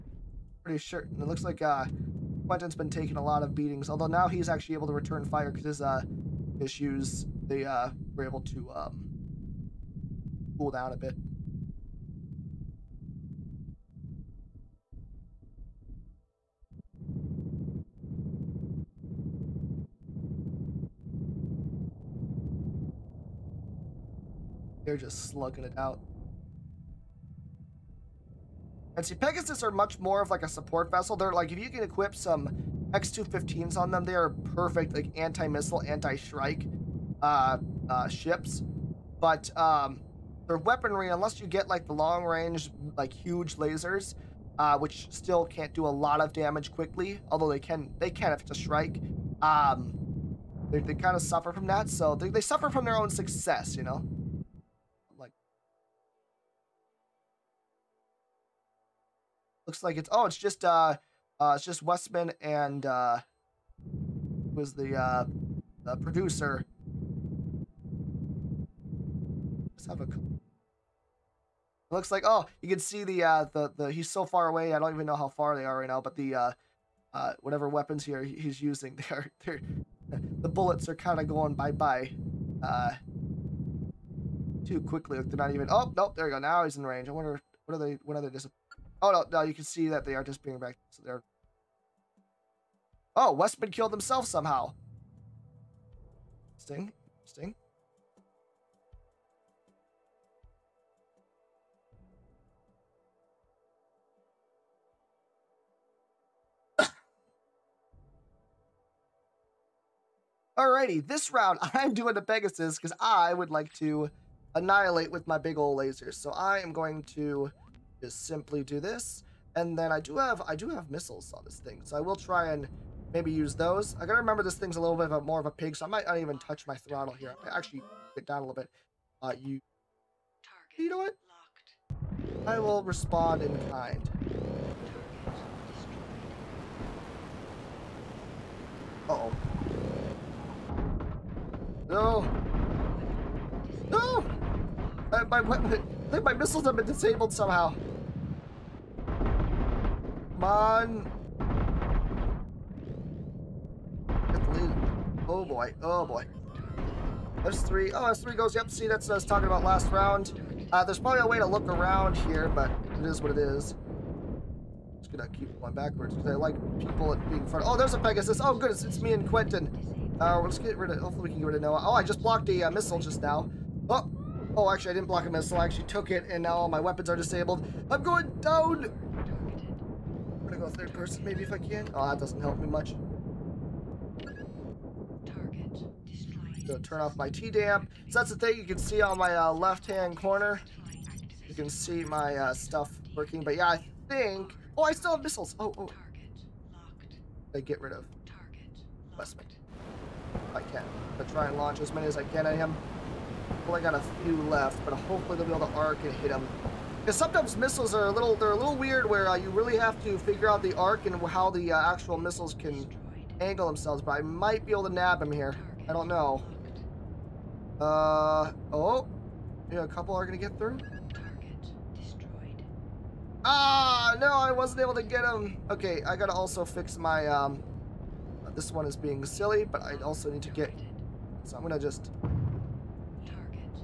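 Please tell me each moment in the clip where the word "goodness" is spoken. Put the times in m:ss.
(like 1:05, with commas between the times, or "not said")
2:48.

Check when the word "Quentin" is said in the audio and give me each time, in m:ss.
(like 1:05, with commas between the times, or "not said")
0:02, 2:49.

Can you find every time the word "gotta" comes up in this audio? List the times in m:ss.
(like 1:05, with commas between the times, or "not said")
2:04, 3:46.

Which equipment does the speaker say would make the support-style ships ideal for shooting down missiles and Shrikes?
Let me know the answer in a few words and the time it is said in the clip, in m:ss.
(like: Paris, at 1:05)
X215s, at 0:32.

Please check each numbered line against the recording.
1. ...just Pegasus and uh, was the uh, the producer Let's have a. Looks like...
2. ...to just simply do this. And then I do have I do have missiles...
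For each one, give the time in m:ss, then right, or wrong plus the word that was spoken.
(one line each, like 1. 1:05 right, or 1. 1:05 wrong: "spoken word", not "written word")
1. 1:01 wrong: "Westman", not "Pegasus"
2. 1:57 right.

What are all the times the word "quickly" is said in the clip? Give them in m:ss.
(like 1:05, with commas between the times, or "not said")
0:46, 1:24.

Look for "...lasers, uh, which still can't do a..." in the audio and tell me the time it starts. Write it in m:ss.
0:43.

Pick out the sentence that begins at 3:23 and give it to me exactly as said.
I got a few left, but hopefully they'll be able to arc and hit him.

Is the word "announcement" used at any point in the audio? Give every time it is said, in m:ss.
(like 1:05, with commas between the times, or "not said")
not said.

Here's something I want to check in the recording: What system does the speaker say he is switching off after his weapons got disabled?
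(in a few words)
T-damp.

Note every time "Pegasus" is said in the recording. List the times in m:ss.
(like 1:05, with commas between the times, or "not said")
0:29, 1:52, 2:48.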